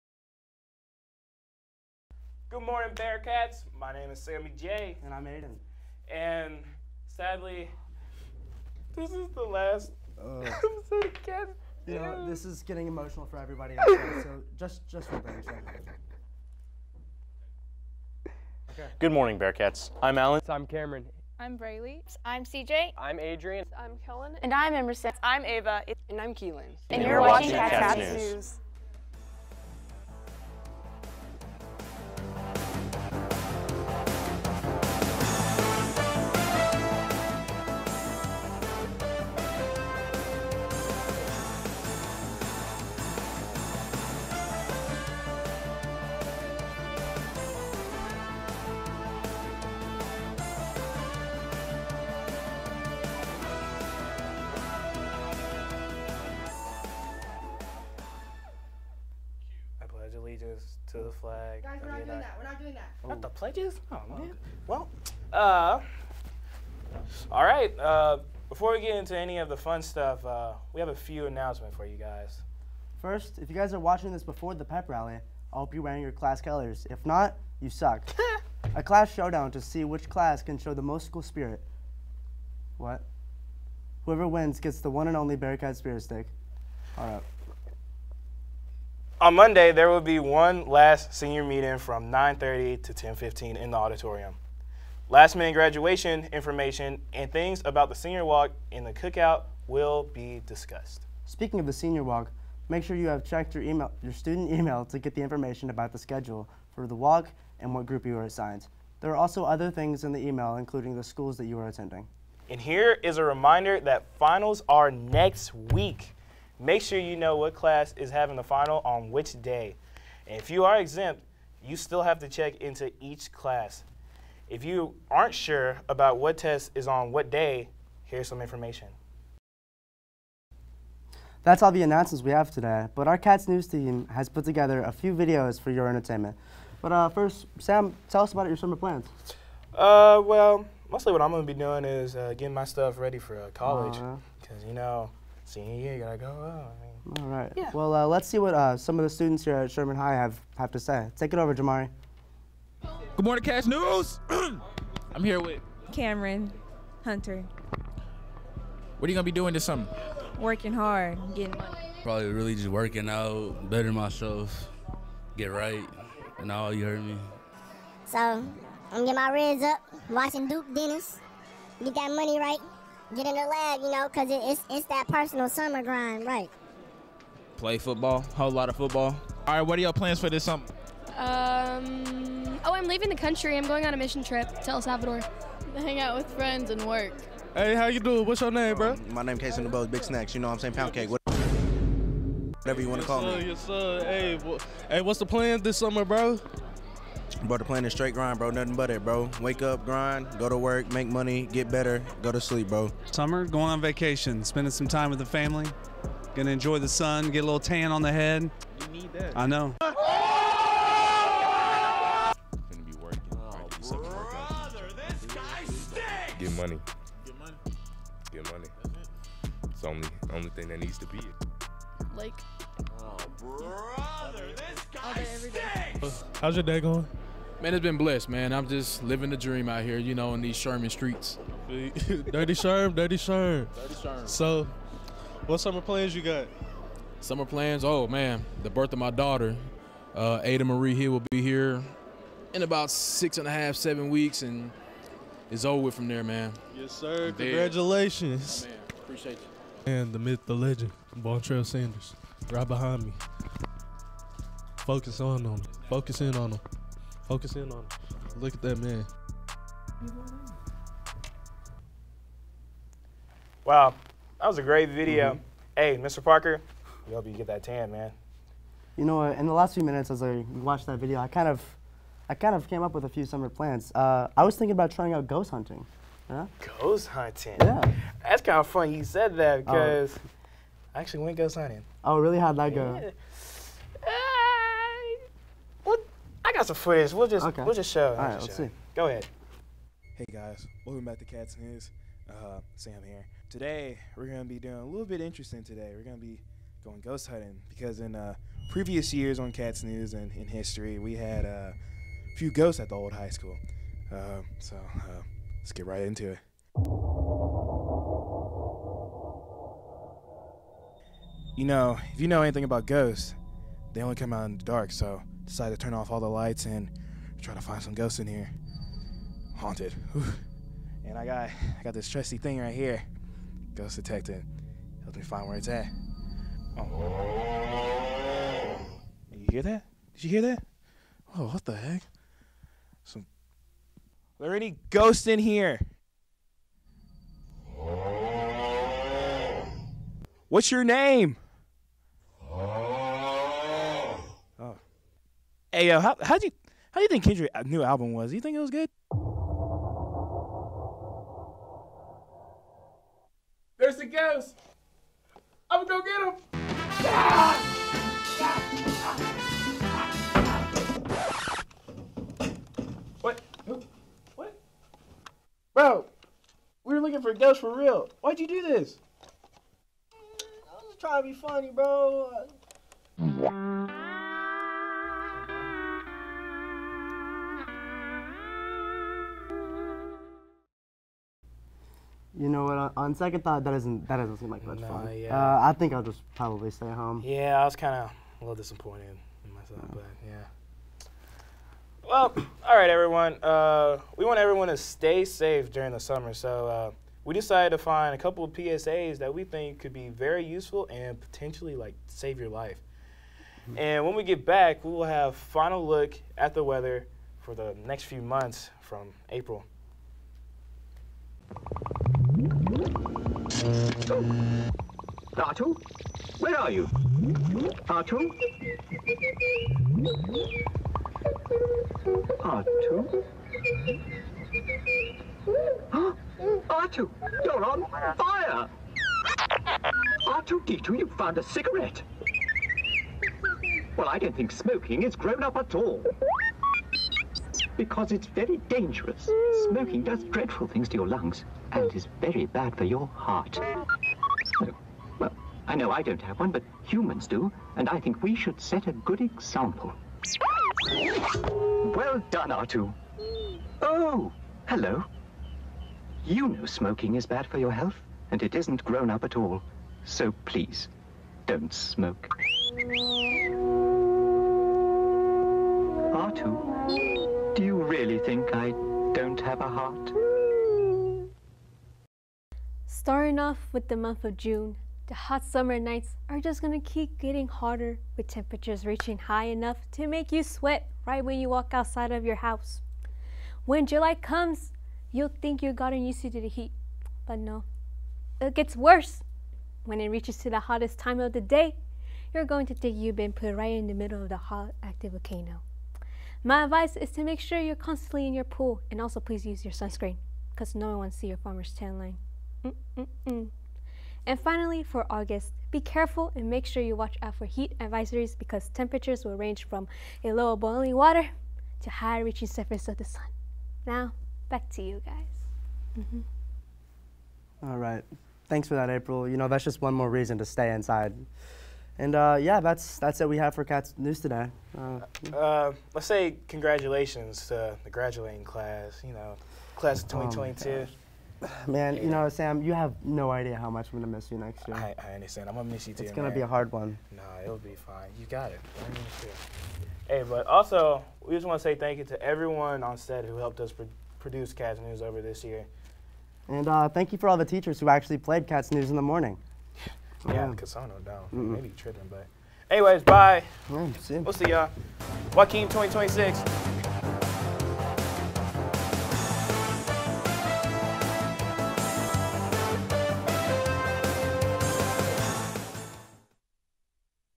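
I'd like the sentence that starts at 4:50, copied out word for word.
Hey guys, welcome back to Cats News.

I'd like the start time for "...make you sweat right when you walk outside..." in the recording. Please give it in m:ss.
8:00.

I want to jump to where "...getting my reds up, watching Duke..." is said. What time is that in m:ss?
2:48.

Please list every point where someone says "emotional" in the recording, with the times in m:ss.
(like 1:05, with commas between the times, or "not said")
0:12.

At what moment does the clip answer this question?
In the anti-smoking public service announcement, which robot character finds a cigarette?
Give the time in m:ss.
7:10.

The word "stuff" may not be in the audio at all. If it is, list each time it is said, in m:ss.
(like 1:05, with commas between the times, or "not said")
1:09, 2:22.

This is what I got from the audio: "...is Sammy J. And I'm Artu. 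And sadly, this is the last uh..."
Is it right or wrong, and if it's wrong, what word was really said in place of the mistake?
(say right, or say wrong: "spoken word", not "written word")
wrong: "Aiden", not "Artu".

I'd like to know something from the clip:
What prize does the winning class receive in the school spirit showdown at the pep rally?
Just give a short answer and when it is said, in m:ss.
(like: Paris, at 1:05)
Bearcat Spirit Stick, at 1:25.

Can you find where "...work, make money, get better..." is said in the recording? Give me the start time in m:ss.
3:20.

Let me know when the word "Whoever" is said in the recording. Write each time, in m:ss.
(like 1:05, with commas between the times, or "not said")
1:24.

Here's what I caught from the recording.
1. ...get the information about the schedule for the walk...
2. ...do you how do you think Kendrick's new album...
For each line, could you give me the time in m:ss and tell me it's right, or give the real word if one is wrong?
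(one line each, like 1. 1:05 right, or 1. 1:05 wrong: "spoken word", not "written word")
1. 1:44 right
2. 5:46 right.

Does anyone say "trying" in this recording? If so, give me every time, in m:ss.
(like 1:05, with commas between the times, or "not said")
4:34, 6:10.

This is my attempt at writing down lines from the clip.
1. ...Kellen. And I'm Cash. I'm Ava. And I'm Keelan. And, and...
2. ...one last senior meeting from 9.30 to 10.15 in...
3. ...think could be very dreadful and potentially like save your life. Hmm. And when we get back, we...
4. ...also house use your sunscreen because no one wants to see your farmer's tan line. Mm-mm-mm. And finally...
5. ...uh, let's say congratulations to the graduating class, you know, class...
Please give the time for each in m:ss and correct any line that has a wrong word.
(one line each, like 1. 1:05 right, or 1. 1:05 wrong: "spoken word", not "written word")
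1. 0:24 wrong: "Emerson", not "Cash"
2. 1:30 right
3. 6:39 wrong: "useful", not "dreadful"
4. 8:19 wrong: "please", not "house"
5. 8:45 right.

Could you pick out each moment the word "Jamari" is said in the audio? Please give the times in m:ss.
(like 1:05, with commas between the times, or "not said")
2:31.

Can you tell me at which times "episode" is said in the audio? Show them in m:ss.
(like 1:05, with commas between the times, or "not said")
0:10.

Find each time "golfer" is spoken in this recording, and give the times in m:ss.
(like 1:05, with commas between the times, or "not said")
not said.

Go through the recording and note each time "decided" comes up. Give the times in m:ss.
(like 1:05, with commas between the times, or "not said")
5:15, 6:37.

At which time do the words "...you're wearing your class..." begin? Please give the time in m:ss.
1:15.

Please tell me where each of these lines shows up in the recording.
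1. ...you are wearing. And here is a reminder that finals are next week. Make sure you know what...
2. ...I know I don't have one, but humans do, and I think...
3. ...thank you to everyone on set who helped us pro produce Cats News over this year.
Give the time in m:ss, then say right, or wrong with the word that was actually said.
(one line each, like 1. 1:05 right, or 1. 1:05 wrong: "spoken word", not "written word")
1. 1:51 wrong: "attending", not "wearing"
2. 7:25 right
3. 9:01 right.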